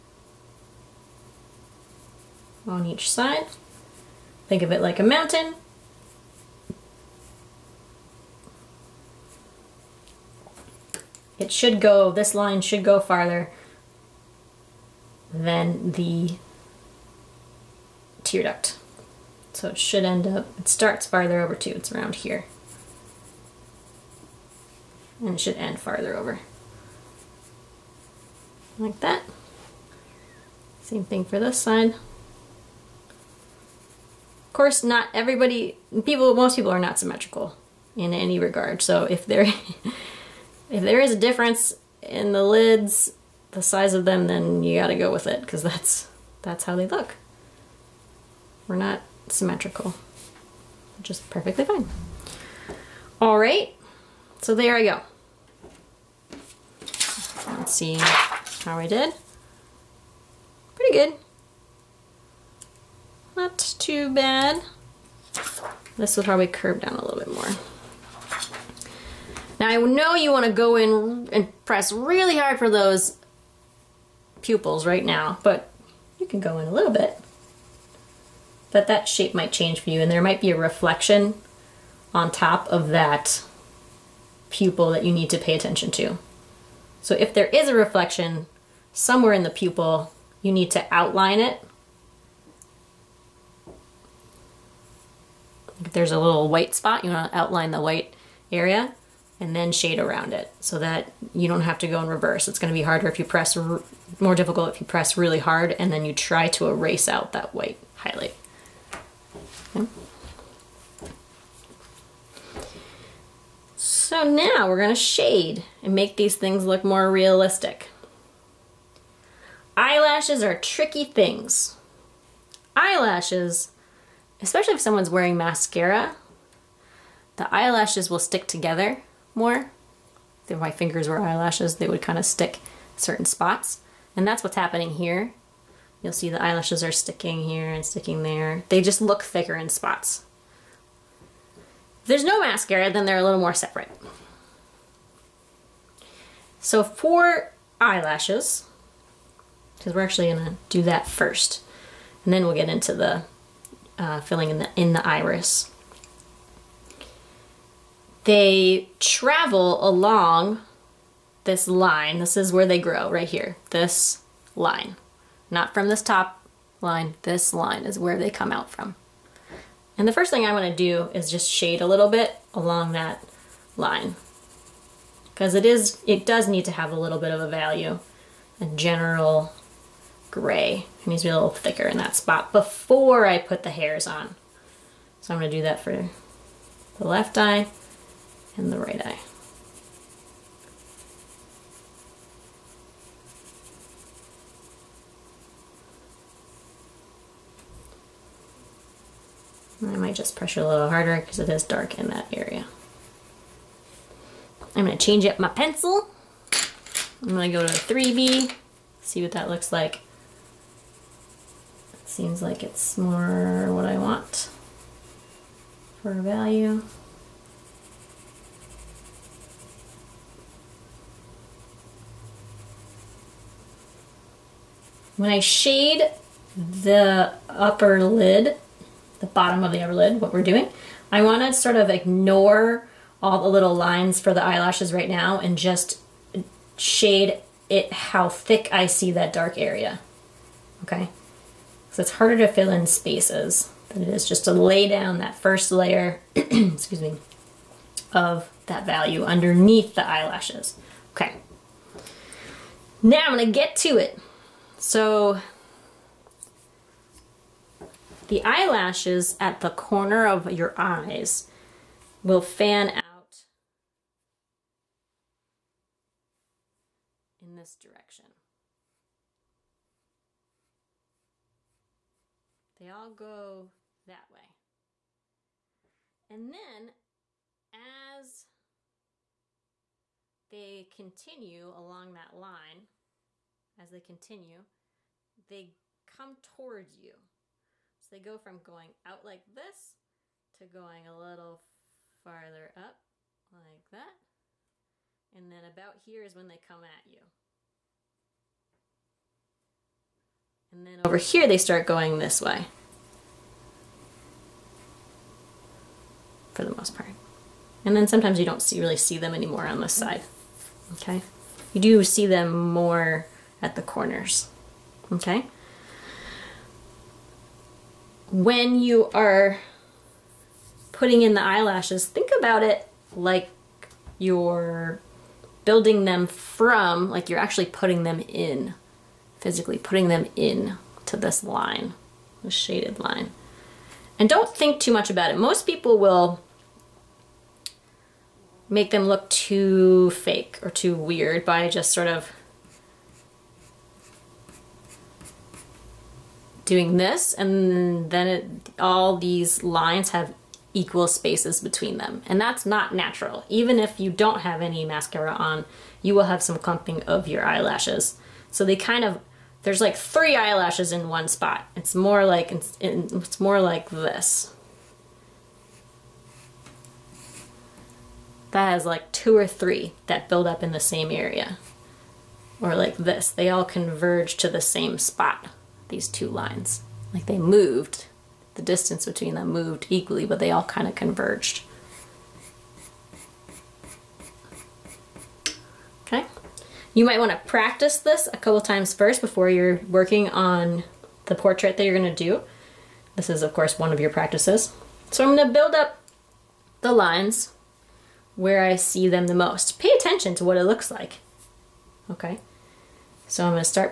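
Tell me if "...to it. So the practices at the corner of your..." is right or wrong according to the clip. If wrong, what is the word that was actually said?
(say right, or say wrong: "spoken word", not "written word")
wrong: "eyelashes", not "practices".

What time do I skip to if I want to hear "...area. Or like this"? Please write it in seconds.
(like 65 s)
371 s.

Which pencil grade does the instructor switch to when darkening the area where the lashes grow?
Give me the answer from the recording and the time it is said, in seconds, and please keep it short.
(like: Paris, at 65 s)
3B, at 207 s.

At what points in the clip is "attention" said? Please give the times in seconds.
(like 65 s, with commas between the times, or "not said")
85 s, 399 s.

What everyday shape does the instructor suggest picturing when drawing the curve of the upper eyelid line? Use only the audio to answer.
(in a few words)
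A mountain.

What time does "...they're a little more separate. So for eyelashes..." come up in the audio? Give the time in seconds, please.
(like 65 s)
143 s.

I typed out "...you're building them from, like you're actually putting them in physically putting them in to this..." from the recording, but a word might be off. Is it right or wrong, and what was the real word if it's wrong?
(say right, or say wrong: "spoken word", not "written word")
right.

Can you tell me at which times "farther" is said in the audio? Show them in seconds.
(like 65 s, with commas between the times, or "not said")
12 s, 21 s, 25 s, 291 s.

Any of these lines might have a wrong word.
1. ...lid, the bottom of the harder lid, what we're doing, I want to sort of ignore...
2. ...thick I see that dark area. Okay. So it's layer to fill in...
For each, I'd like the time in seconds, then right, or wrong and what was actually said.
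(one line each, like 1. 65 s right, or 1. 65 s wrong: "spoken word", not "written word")
1. 228 s wrong: "upper", not "harder"
2. 238 s wrong: "harder", not "layer".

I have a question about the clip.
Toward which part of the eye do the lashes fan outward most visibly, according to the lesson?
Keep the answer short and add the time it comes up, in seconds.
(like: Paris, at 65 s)
The corners, at 313 s.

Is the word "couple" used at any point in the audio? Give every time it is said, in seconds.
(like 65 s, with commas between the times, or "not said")
388 s.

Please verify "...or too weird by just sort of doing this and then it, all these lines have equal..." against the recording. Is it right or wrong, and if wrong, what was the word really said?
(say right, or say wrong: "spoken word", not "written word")
right.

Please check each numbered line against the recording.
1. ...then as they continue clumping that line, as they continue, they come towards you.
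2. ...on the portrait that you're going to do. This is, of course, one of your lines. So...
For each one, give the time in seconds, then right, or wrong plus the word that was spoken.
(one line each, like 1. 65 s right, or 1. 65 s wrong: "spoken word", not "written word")
1. 276 s wrong: "along", not "clumping"
2. 390 s wrong: "practices", not "lines".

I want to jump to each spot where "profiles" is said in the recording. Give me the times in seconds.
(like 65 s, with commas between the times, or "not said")
not said.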